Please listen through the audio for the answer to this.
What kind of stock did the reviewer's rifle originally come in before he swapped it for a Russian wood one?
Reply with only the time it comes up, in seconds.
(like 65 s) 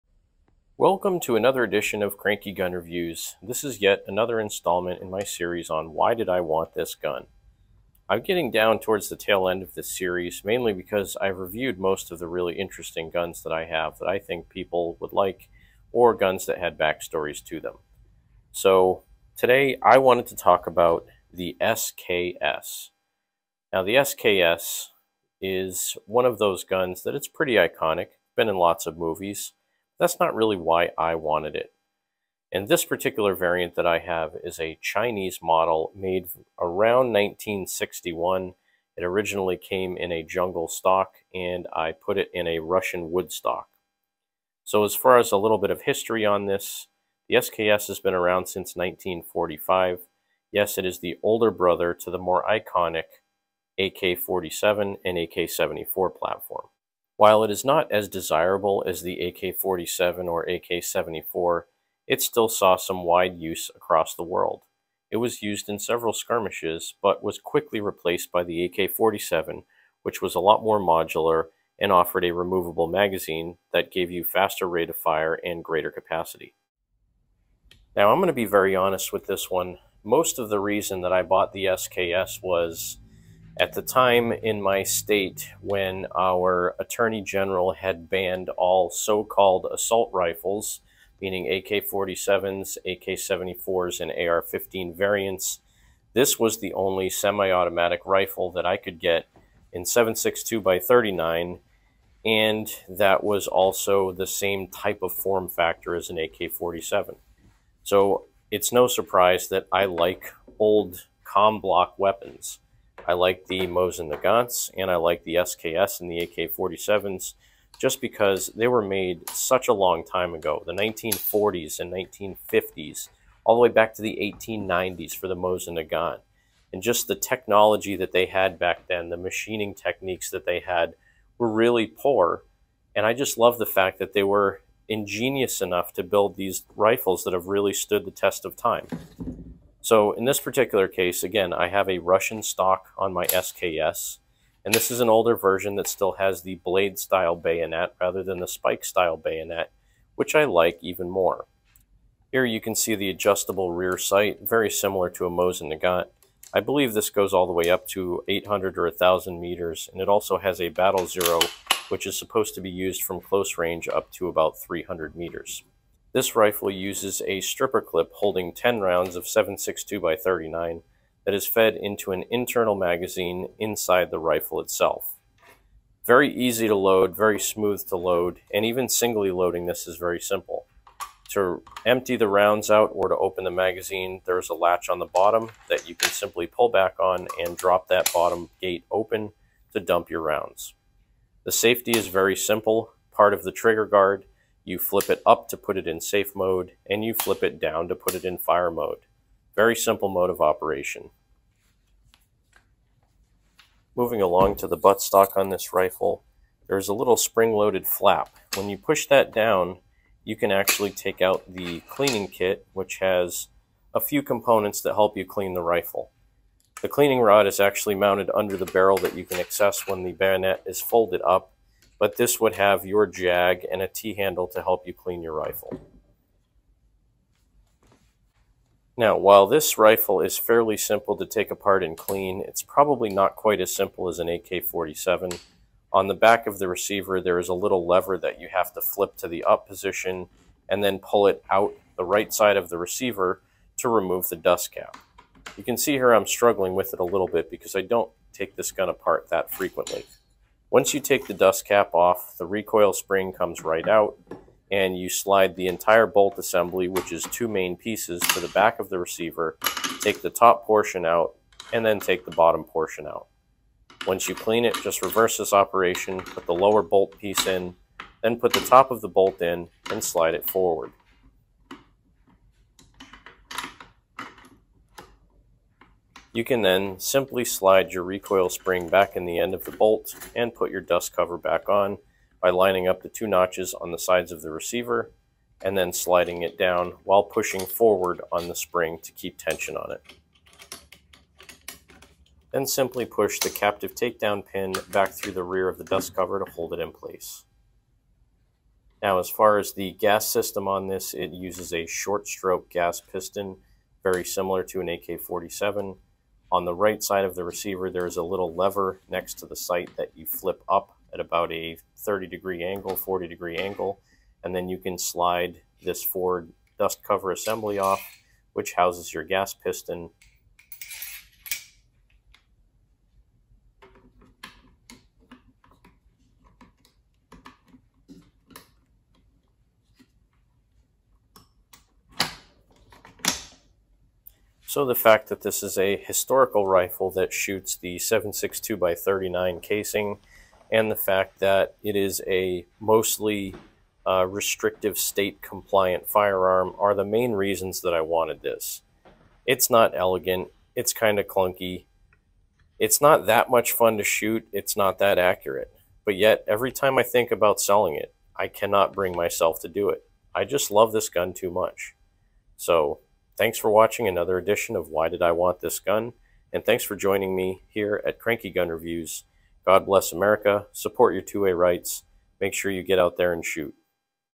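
40 s.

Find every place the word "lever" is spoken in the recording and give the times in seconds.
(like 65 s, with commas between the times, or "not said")
237 s, 308 s.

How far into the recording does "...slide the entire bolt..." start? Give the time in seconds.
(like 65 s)
255 s.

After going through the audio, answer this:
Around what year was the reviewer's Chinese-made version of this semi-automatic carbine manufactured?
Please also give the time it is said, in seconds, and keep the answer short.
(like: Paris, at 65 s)
1961, at 37 s.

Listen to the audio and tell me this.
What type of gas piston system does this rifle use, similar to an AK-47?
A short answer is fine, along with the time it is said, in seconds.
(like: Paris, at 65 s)
short stroke gas piston, at 301 s.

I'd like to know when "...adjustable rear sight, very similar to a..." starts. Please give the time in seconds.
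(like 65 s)
153 s.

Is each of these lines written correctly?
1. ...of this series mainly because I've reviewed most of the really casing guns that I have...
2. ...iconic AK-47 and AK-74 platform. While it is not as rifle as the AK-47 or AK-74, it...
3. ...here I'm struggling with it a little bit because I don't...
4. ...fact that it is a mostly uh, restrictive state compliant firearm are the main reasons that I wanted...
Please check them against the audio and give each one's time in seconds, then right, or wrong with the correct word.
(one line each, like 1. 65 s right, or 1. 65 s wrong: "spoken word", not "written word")
1. 9 s wrong: "interesting", not "casing"
2. 52 s wrong: "desirable", not "rifle"
3. 245 s right
4. 340 s right.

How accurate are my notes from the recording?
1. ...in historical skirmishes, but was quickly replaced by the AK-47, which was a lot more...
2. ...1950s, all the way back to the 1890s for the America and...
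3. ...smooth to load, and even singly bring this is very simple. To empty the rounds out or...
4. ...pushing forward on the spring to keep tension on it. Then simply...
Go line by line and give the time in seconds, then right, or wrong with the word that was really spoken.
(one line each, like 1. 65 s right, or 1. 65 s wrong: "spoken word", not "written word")
1. 65 s wrong: "several", not "historical"
2. 121 s wrong: "Mosin", not "America"
3. 177 s wrong: "loading", not "bring"
4. 287 s right.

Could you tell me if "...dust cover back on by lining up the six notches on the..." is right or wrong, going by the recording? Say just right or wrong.
wrong.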